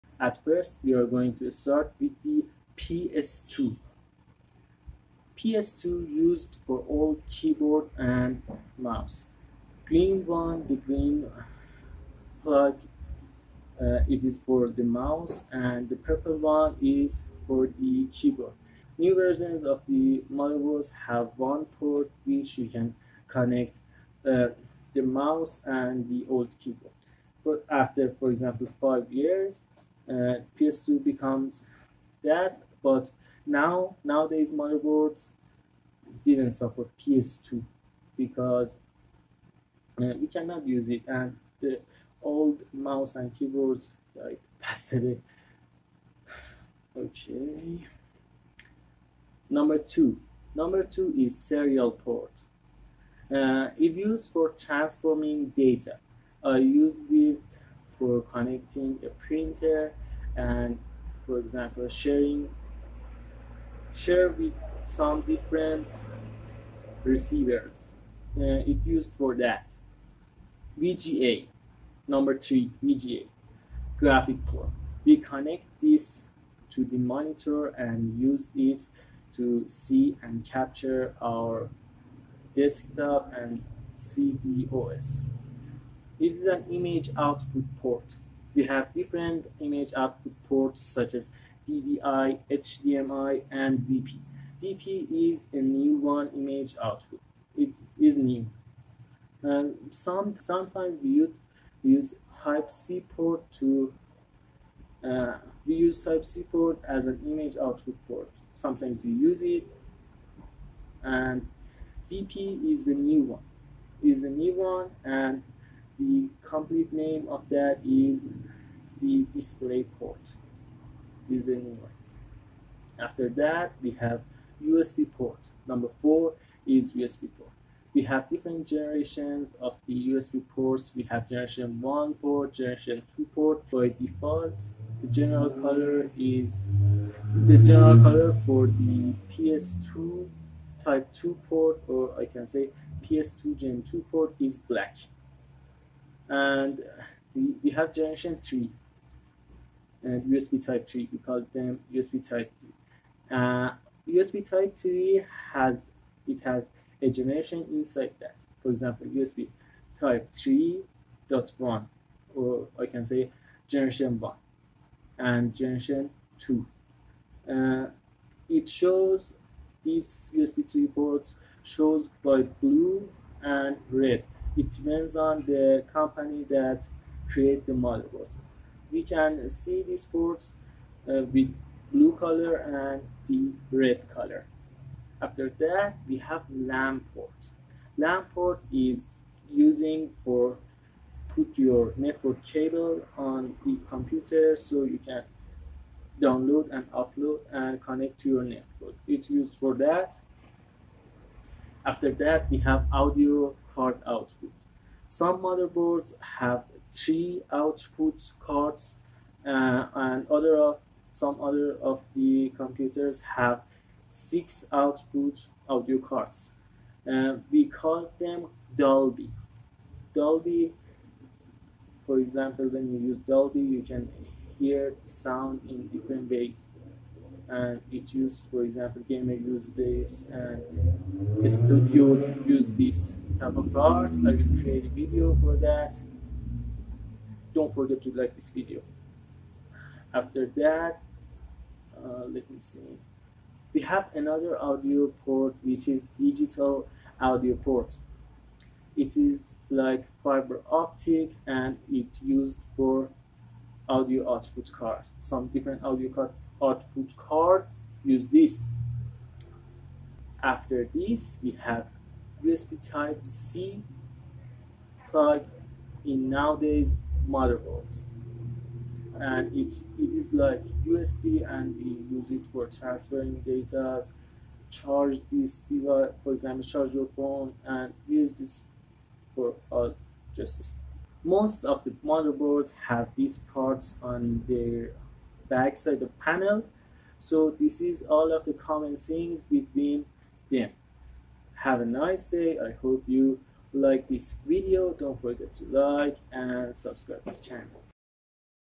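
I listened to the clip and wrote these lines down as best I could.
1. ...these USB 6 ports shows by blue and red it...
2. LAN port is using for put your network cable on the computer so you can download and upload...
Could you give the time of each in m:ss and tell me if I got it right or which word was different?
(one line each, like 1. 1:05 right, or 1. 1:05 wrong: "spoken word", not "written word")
1. 2:49 wrong: "3", not "6"
2. 3:07 right.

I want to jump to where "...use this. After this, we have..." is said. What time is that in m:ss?
4:18.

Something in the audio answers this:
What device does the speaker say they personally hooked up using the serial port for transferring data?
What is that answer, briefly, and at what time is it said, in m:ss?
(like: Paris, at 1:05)
A printer, at 0:59.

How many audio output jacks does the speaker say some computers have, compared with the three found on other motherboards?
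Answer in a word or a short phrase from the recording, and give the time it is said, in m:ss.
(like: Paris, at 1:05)
6, at 3:34.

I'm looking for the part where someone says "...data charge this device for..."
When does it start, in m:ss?
4:33.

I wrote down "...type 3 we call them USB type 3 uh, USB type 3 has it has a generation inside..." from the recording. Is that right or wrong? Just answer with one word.
right.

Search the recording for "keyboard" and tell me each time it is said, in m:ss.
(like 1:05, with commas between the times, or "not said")
0:07, 0:18, 0:26, 0:43.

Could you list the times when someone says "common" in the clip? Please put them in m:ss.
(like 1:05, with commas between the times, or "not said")
4:48.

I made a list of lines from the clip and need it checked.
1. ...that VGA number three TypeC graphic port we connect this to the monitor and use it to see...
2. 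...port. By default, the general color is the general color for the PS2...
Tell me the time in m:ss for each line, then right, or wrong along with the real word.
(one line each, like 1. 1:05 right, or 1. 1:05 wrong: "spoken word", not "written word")
1. 1:09 wrong: "VGA", not "TypeC"
2. 2:13 right.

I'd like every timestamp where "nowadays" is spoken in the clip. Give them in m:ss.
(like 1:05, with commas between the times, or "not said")
0:34, 4:26.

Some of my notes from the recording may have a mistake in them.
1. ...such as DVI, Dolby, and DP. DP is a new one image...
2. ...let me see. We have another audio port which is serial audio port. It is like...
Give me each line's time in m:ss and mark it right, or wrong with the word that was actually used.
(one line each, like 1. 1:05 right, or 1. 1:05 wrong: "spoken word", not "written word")
1. 1:30 wrong: "HDMI", not "Dolby"
2. 4:02 wrong: "digital", not "serial".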